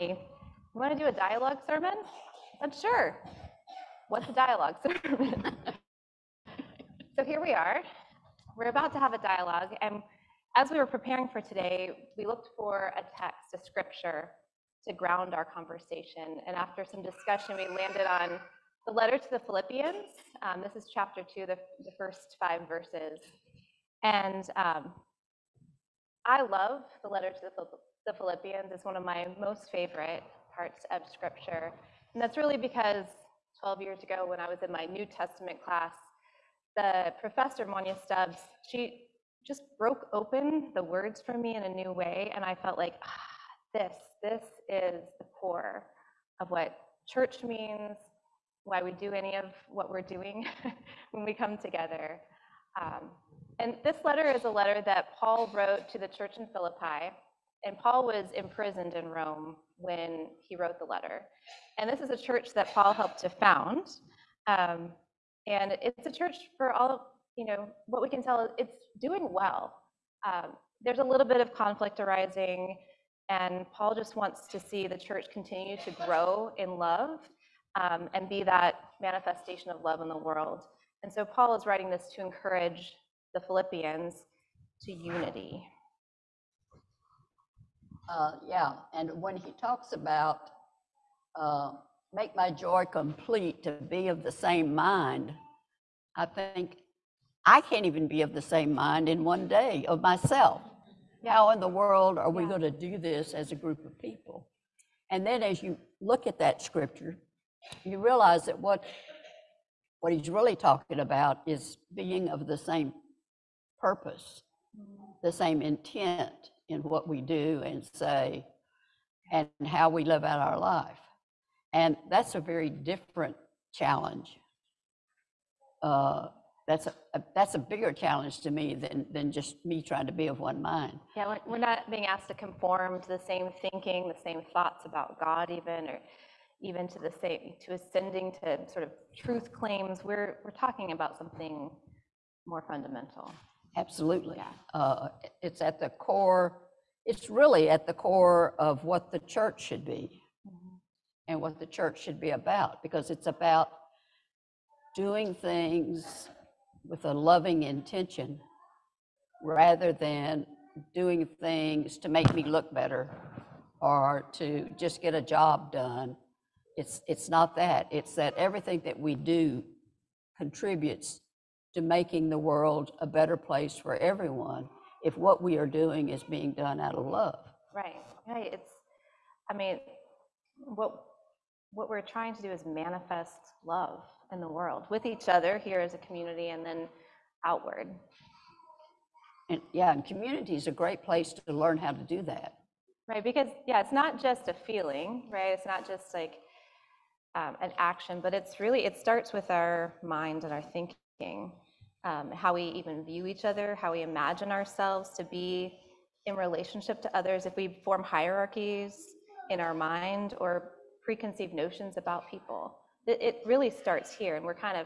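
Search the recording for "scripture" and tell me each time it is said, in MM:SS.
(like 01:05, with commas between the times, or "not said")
00:13, 00:31, 01:46.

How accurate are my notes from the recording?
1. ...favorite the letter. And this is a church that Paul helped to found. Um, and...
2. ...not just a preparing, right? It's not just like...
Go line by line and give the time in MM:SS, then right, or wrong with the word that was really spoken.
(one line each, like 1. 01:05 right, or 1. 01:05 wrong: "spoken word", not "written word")
1. 01:00 wrong: "wrote", not "favorite"
2. 03:13 wrong: "feeling", not "preparing".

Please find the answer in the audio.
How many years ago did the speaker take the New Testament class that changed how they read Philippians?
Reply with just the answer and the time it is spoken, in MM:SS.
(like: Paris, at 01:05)
12, at 00:33.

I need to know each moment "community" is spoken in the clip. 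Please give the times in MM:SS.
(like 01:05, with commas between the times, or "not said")
03:05, 03:10.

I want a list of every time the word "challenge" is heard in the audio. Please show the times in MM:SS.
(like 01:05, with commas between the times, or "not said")
02:03, 02:07.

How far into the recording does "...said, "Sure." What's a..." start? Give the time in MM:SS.
00:02.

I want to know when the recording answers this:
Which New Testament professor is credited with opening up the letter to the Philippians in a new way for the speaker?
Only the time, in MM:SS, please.
00:37.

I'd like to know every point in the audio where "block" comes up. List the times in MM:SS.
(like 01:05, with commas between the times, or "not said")
not said.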